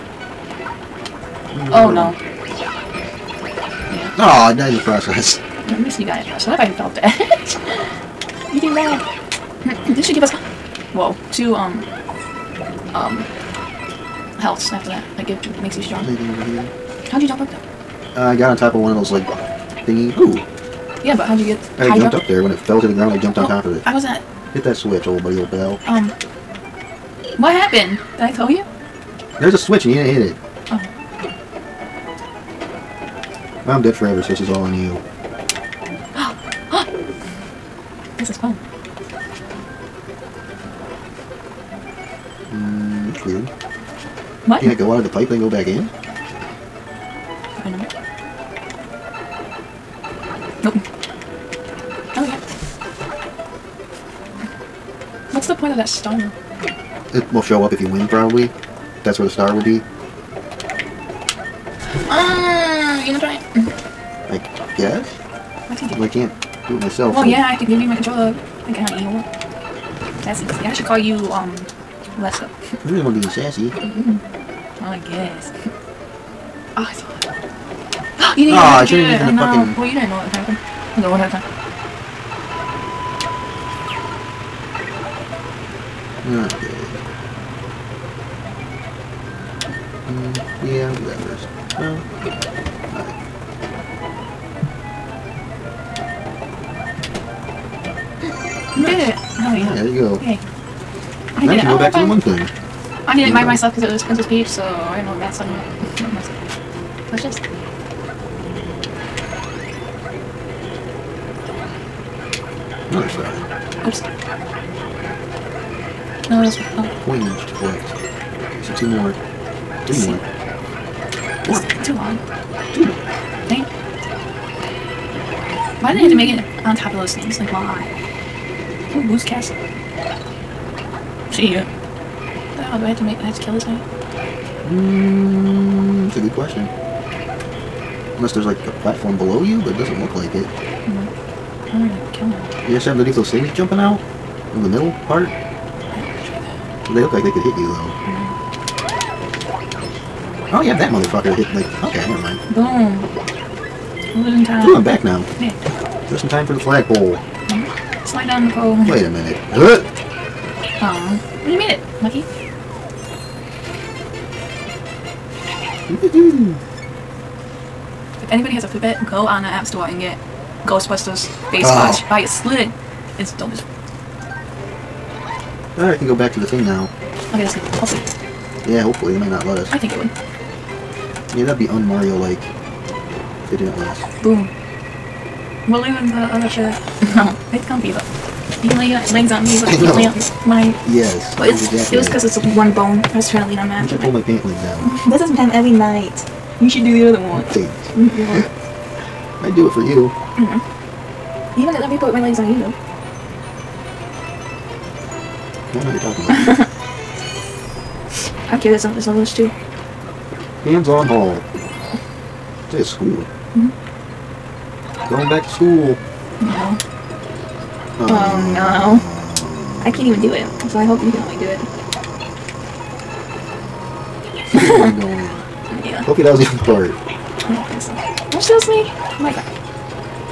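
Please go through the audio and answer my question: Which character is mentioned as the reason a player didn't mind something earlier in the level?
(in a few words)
Princess Peach.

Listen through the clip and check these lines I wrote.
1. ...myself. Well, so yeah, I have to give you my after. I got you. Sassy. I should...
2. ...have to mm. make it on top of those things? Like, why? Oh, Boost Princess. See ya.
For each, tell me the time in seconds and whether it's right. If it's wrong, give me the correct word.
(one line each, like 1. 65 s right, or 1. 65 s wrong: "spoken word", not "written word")
1. 66 s wrong: "controller", not "after"
2. 126 s wrong: "Castle", not "Princess".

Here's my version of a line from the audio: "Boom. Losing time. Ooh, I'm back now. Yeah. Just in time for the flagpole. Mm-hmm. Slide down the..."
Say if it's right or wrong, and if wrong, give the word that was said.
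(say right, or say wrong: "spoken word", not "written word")
right.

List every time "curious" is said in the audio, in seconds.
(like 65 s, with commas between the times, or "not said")
208 s.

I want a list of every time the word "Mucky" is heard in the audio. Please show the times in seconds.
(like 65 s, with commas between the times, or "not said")
162 s.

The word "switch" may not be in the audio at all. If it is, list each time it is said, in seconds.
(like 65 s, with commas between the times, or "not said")
24 s, 29 s.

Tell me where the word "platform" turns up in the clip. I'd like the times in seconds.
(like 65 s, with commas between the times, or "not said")
138 s.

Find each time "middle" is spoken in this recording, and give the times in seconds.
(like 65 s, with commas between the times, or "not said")
144 s.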